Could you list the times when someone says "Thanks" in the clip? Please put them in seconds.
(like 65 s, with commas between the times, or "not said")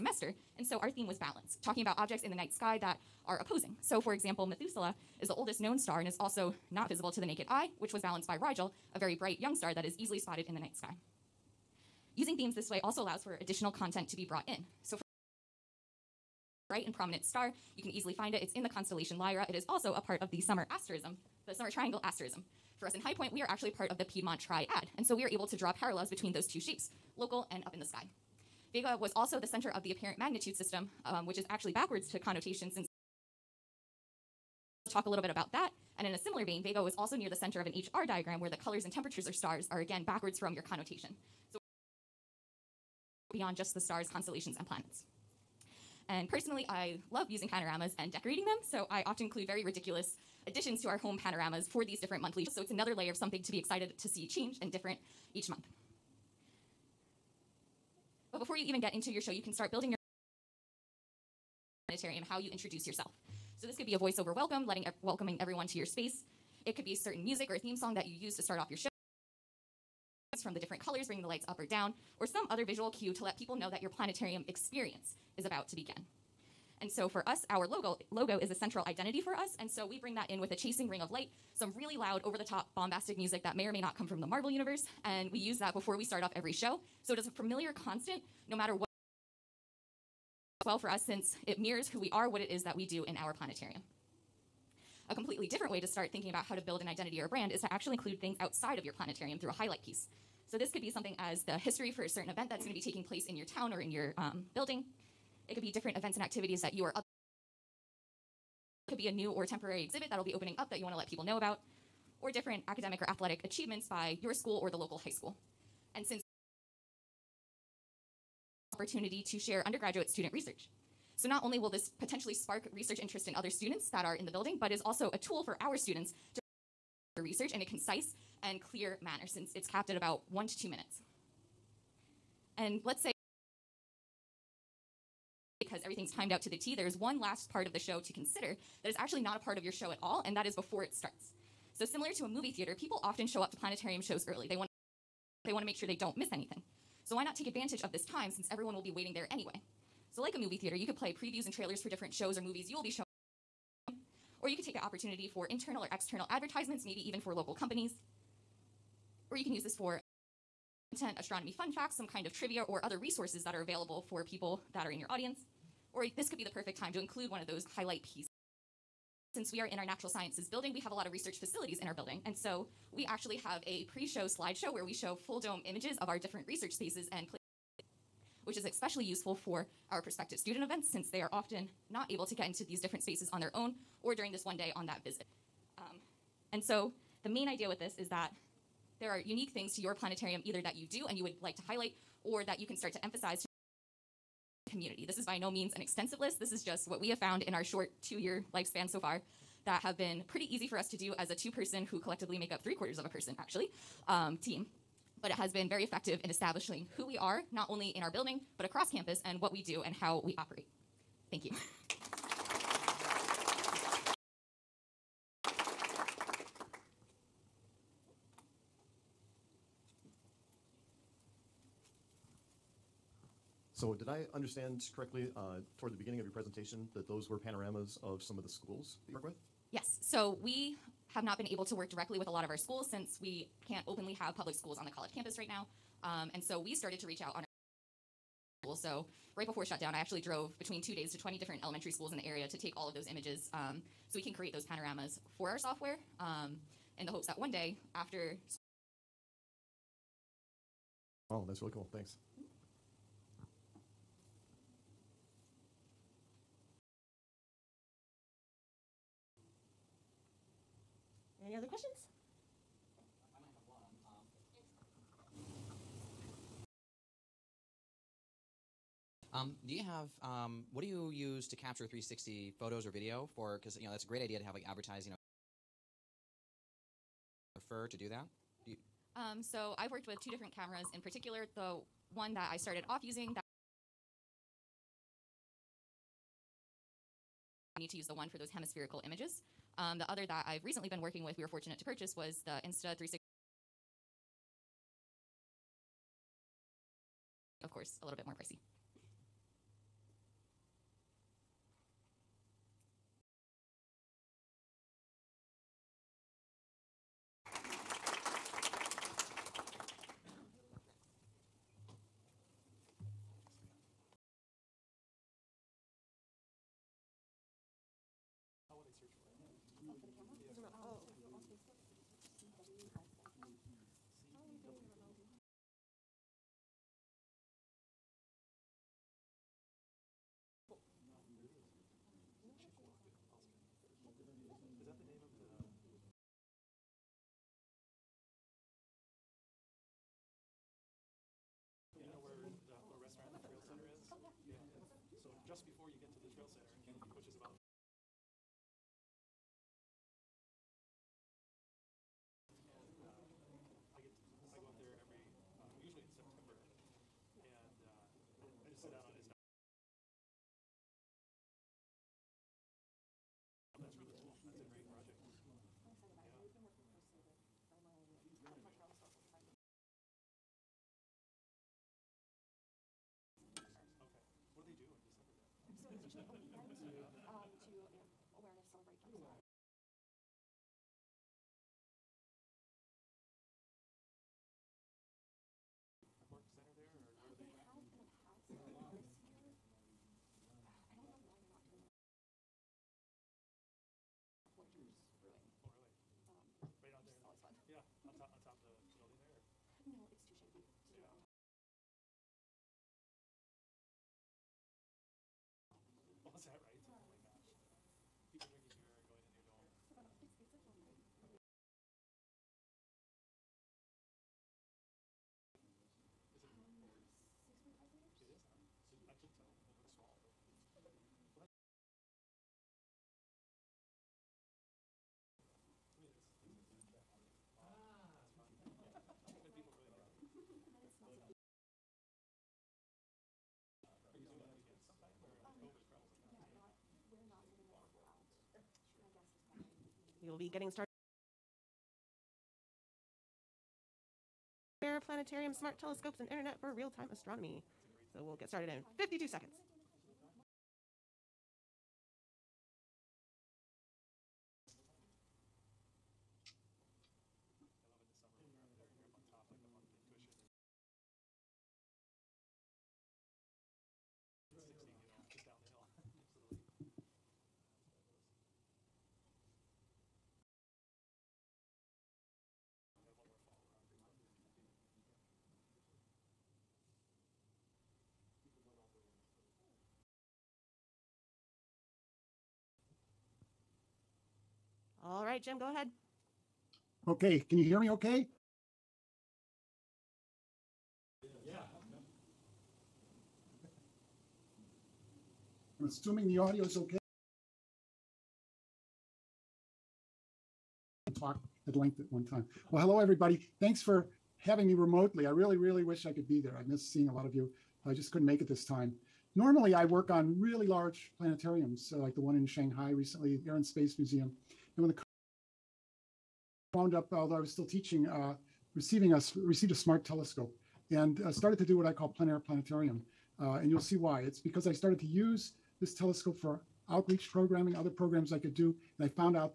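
211 s, 251 s, 503 s.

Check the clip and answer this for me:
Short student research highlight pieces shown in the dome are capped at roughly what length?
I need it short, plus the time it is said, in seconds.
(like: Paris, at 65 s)
1 to 2 minutes, at 130 s.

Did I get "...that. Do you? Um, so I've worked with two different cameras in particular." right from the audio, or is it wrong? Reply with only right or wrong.
right.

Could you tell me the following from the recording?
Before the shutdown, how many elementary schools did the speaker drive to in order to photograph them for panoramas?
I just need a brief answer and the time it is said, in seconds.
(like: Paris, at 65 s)
20, at 241 s.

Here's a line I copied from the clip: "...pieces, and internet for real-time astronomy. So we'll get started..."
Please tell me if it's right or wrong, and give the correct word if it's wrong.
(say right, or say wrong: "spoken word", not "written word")
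wrong: "telescopes", not "pieces".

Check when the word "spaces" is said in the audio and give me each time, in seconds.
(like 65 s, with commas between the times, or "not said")
65 s, 176 s, 183 s, 513 s.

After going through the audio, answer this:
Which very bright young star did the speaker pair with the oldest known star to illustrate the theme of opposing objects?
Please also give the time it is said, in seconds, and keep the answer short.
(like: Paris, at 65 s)
Rigel, at 8 s.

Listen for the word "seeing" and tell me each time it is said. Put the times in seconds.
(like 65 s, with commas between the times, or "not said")
506 s.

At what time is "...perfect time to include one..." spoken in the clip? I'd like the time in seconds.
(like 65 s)
166 s.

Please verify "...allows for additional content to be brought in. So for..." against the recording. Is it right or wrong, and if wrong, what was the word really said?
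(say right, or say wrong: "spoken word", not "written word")
right.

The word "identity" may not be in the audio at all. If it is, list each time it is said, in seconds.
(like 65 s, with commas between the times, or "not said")
78 s, 96 s.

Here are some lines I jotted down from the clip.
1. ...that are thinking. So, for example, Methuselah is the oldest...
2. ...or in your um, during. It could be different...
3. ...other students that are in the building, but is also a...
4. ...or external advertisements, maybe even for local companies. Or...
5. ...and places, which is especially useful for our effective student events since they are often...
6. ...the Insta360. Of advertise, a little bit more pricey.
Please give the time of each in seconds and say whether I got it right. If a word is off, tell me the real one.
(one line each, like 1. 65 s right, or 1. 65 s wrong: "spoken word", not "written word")
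1. 2 s wrong: "opposing", not "thinking"
2. 103 s wrong: "building", not "during"
3. 123 s right
4. 155 s right
5. 177 s wrong: "prospective", not "effective"
6. 292 s wrong: "course", not "advertise".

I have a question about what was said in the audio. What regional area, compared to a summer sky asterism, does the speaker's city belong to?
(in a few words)
Piedmont Triad.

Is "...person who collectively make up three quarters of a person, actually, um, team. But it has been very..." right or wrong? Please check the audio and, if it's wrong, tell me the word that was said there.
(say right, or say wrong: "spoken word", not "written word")
right.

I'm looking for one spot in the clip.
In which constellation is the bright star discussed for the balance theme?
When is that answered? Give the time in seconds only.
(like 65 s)
19 s.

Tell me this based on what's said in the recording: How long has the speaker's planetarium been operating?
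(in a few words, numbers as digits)
2 years.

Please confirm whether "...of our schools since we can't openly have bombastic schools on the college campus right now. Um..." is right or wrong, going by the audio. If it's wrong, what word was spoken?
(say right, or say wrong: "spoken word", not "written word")
wrong: "public", not "bombastic".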